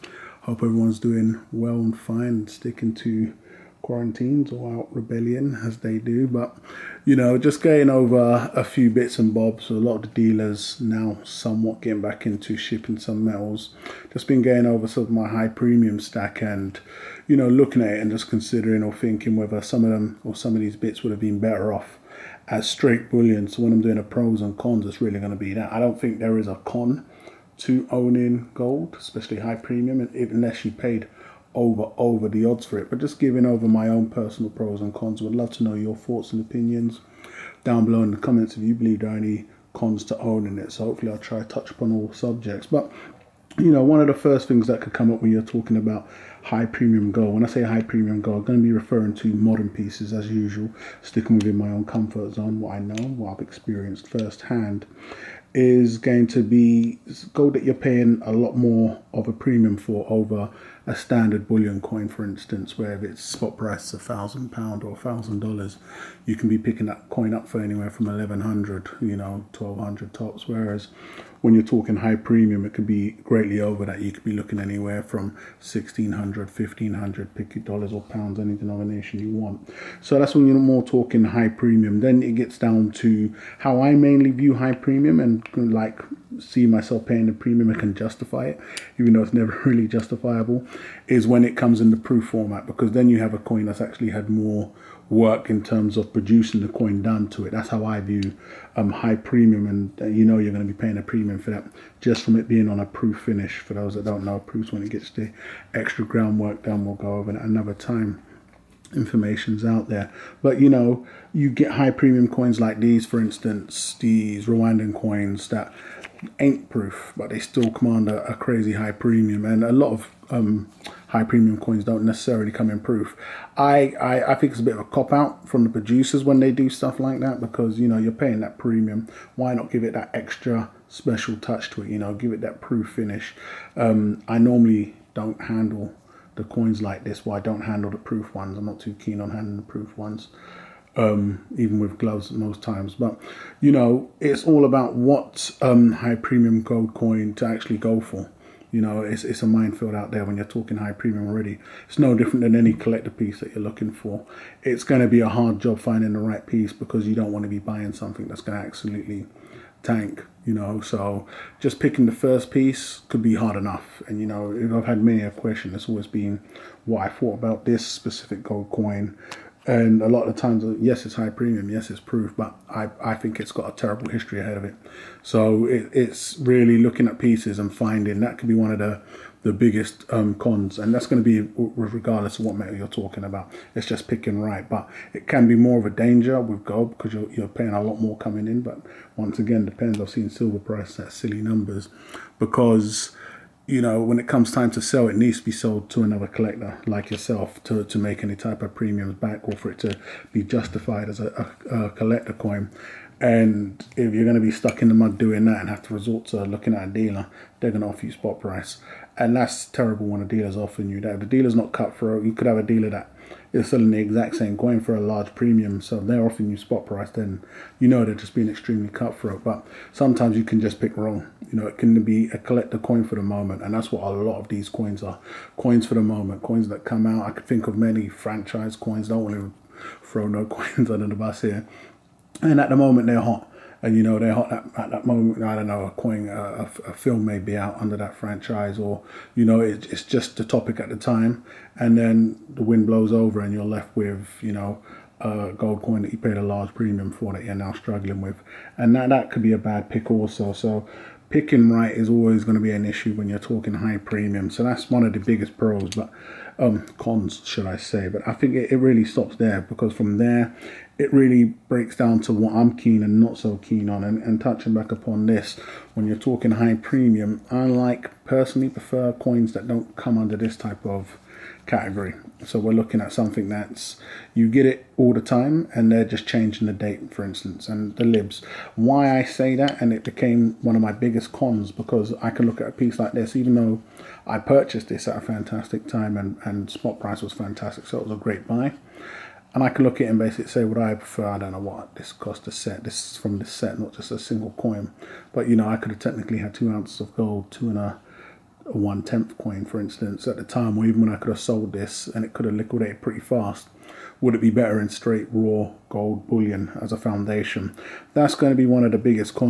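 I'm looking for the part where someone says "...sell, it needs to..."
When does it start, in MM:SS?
03:14.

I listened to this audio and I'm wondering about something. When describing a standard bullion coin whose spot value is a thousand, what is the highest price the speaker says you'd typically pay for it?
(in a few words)
1200.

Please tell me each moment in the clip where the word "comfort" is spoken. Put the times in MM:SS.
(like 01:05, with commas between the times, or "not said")
00:51.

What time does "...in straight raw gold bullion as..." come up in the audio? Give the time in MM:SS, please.
05:04.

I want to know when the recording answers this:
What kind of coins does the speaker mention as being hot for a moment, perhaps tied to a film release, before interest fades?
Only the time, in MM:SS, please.
03:48.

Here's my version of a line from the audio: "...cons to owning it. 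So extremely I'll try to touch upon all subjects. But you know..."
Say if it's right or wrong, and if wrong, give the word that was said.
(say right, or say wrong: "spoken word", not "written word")
wrong: "hopefully", not "extremely".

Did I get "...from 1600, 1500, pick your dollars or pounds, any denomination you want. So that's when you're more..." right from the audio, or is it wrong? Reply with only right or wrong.
right.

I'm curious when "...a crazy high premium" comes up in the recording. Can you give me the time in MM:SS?
01:58.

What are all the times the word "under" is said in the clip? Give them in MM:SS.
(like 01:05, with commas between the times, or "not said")
03:50, 03:57, 04:30.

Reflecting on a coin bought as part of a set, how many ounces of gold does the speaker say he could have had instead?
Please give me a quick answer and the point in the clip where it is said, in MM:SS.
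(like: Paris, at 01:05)
2, at 04:56.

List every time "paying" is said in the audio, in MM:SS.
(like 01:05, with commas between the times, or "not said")
00:57, 01:27, 01:40, 02:08, 03:07.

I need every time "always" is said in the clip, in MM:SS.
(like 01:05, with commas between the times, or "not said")
02:45, 04:12.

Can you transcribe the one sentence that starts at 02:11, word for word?
You know, give it that proof finish.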